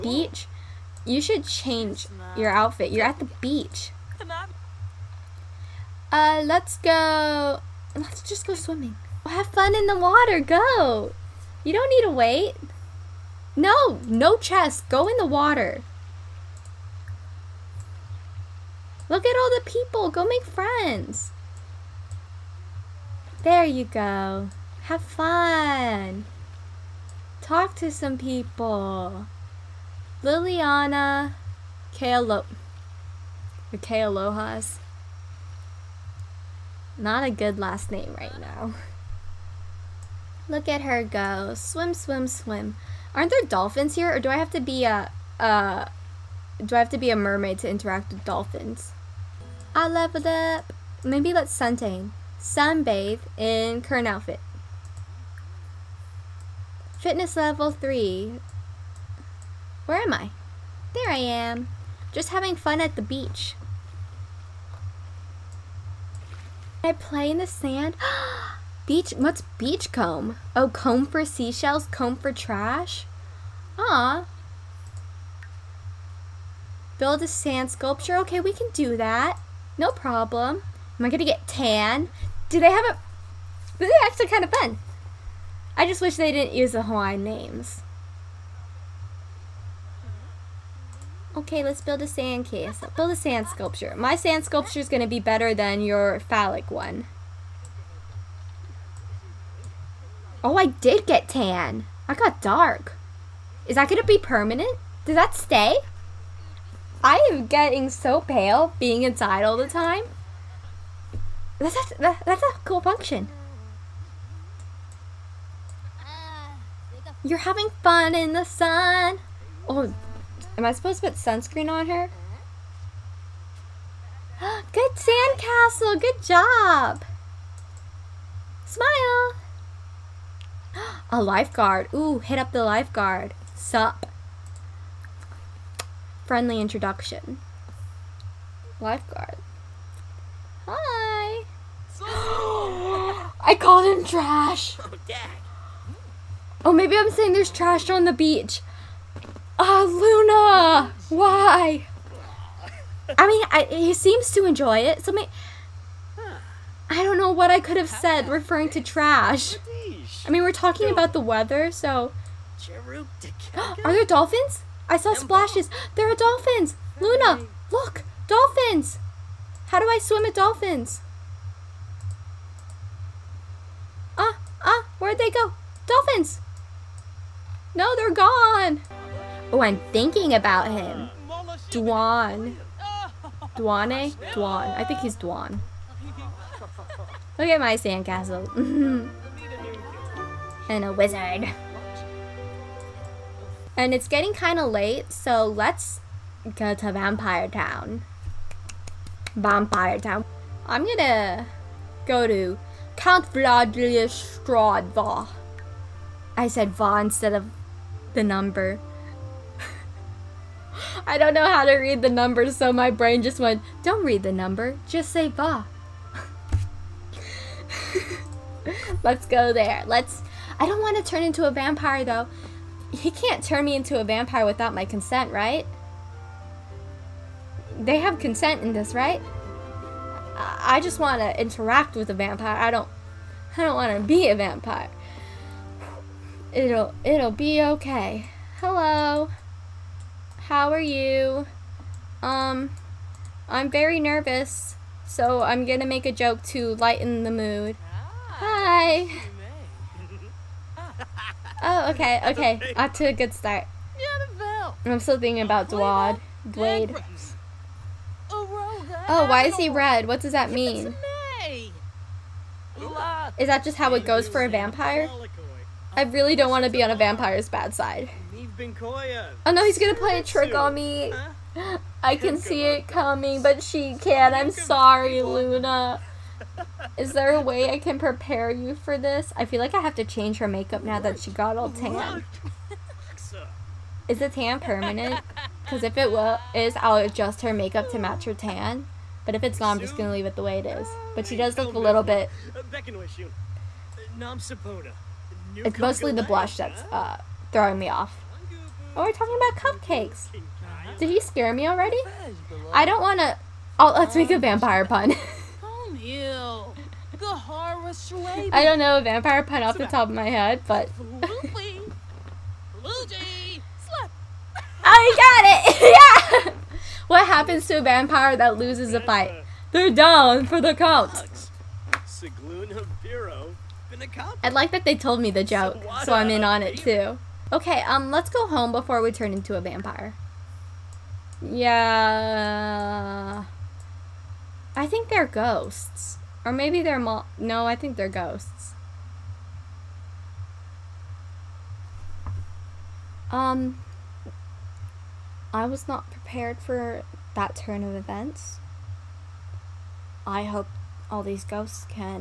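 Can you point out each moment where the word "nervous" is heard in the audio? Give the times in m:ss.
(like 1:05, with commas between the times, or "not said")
4:03.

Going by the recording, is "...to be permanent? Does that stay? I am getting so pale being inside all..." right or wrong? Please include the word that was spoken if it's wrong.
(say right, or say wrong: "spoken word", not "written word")
right.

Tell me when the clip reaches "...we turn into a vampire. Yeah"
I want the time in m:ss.
5:28.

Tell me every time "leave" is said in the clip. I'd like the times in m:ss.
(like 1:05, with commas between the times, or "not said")
4:50.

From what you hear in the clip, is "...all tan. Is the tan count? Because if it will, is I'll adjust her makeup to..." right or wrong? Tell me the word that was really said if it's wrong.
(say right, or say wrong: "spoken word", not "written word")
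wrong: "permanent", not "count".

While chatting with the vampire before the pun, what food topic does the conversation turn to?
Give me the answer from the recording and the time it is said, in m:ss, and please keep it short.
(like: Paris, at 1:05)
Cupcakes, at 4:59.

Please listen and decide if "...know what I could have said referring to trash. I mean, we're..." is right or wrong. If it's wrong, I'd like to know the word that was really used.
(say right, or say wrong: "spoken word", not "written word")
right.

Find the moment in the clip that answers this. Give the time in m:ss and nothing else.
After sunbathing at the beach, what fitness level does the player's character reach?
0:56.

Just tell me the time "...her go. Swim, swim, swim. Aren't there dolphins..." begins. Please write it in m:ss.
0:40.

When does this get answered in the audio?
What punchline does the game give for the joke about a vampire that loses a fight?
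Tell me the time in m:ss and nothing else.
5:19.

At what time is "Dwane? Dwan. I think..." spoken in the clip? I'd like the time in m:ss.
3:03.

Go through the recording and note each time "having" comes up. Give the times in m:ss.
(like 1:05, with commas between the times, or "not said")
1:02, 1:57.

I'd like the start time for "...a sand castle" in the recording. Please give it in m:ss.
1:32.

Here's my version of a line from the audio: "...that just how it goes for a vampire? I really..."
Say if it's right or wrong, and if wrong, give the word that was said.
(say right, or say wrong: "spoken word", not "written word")
right.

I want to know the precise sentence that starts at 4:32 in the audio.
I can see it coming, but she can't.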